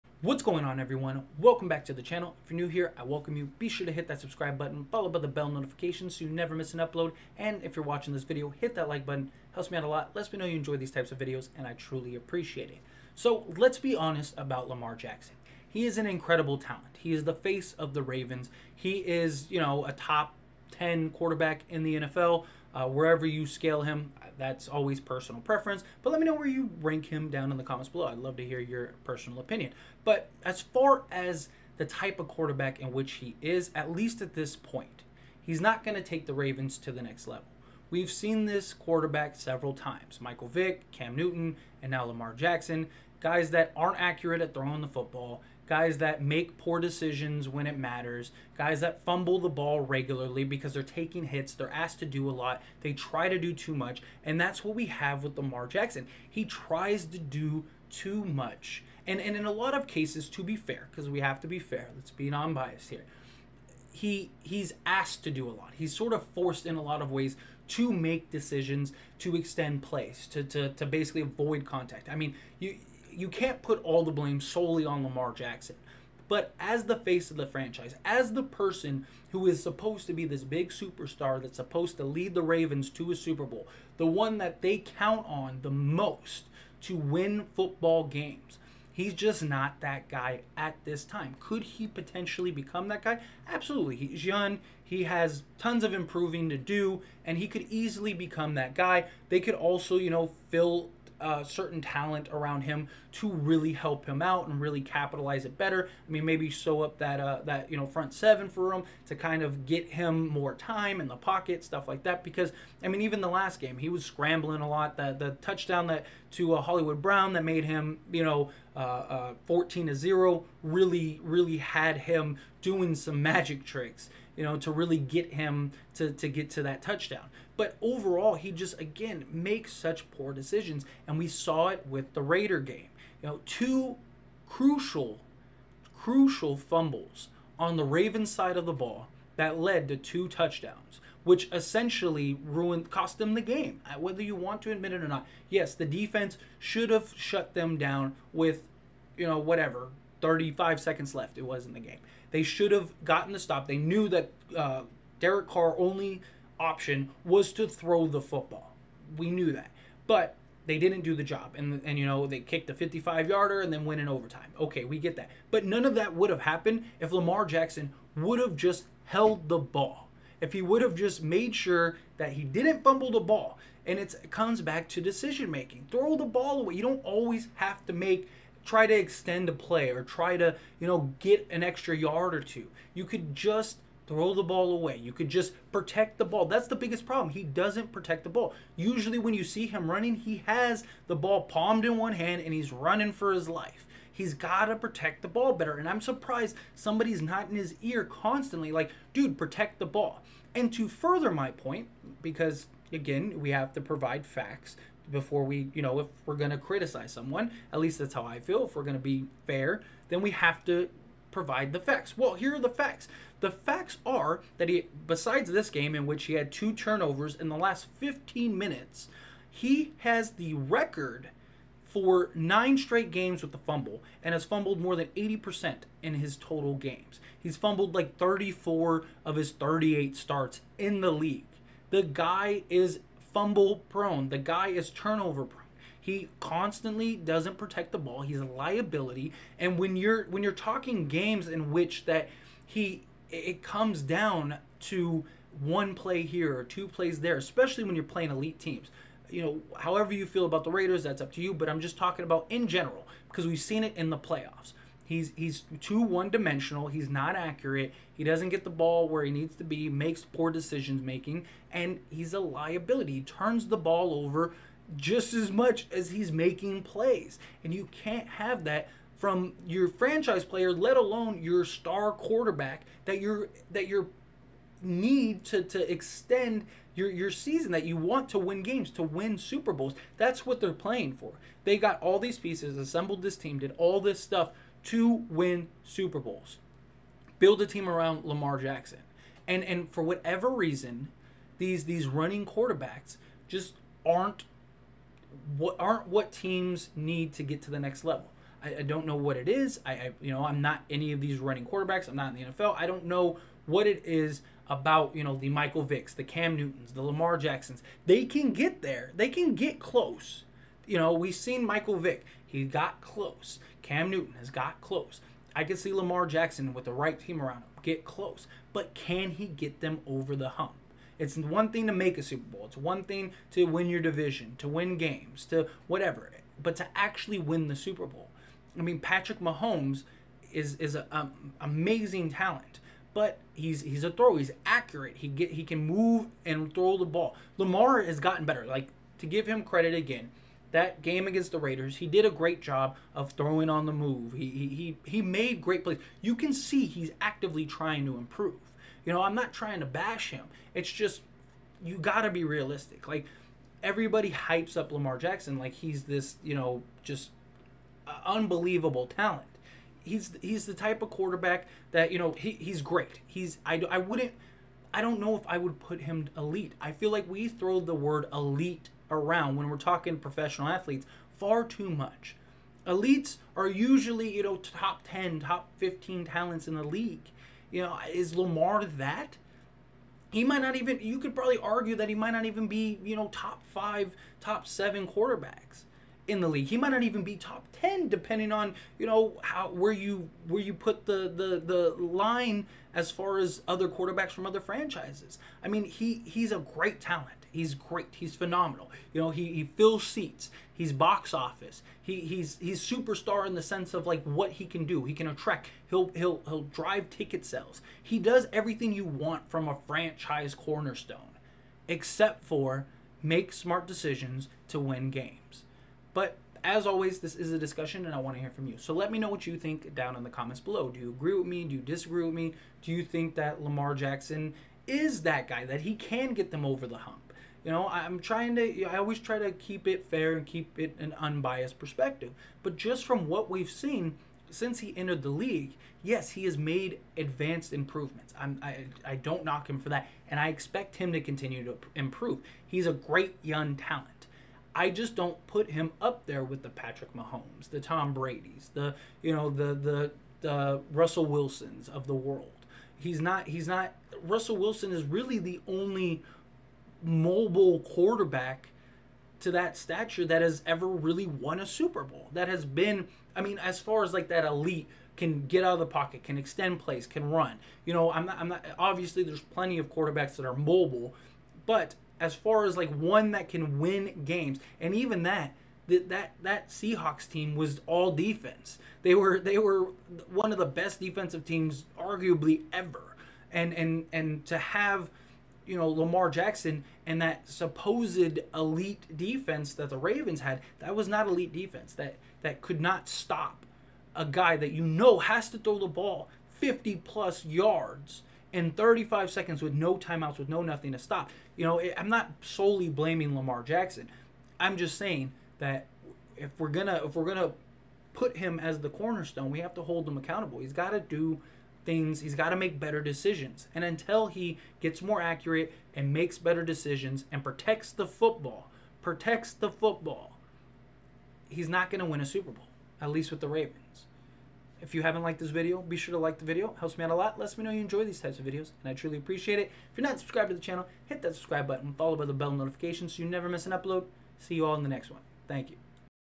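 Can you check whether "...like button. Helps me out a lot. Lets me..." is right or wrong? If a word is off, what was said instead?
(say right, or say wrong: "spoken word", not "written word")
right.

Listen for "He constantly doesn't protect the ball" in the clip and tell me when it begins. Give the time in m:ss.
3:55.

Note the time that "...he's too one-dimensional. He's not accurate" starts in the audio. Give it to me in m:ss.
4:15.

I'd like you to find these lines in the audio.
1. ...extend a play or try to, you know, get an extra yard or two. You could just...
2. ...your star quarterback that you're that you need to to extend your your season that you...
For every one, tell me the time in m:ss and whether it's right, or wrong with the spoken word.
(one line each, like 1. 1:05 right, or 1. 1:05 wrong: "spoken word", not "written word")
1. 2:58 right
2. 4:31 right.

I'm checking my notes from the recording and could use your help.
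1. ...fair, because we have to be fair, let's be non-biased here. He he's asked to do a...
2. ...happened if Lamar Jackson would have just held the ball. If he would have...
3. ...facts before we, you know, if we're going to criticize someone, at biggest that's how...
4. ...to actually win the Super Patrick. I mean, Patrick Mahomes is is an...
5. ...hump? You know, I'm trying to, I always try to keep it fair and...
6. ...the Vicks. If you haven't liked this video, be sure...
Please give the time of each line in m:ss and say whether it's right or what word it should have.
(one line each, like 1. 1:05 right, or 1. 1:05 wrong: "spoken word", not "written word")
1. 1:00 right
2. 2:46 right
3. 3:24 wrong: "least", not "biggest"
4. 5:26 wrong: "Bowl", not "Patrick"
5. 7:06 right
6. 8:43 wrong: "Ravens", not "Vicks".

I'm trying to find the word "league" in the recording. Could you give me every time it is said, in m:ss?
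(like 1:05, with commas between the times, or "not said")
3:51, 6:16, 6:26, 7:15.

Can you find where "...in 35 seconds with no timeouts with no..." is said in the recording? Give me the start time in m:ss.
8:18.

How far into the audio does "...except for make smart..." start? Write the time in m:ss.
6:51.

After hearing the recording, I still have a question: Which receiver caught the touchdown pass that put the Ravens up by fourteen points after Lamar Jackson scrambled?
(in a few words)
Hollywood Brown.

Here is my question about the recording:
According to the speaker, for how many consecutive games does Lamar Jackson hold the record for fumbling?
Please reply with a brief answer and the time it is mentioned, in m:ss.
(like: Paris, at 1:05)
9, at 3:42.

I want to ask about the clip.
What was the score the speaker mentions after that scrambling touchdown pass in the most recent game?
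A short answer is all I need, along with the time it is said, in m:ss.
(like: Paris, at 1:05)
14 to 0, at 1:59.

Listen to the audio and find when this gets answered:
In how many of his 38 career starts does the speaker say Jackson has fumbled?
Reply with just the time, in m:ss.
3:48.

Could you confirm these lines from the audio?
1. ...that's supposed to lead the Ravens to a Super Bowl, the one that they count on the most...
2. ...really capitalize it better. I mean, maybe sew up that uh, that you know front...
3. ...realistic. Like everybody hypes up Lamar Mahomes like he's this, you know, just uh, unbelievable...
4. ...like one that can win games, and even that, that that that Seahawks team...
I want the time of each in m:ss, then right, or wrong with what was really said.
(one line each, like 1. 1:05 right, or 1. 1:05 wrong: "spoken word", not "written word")
1. 1:21 right
2. 1:44 right
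3. 5:52 wrong: "Jackson", not "Mahomes"
4. 7:52 right.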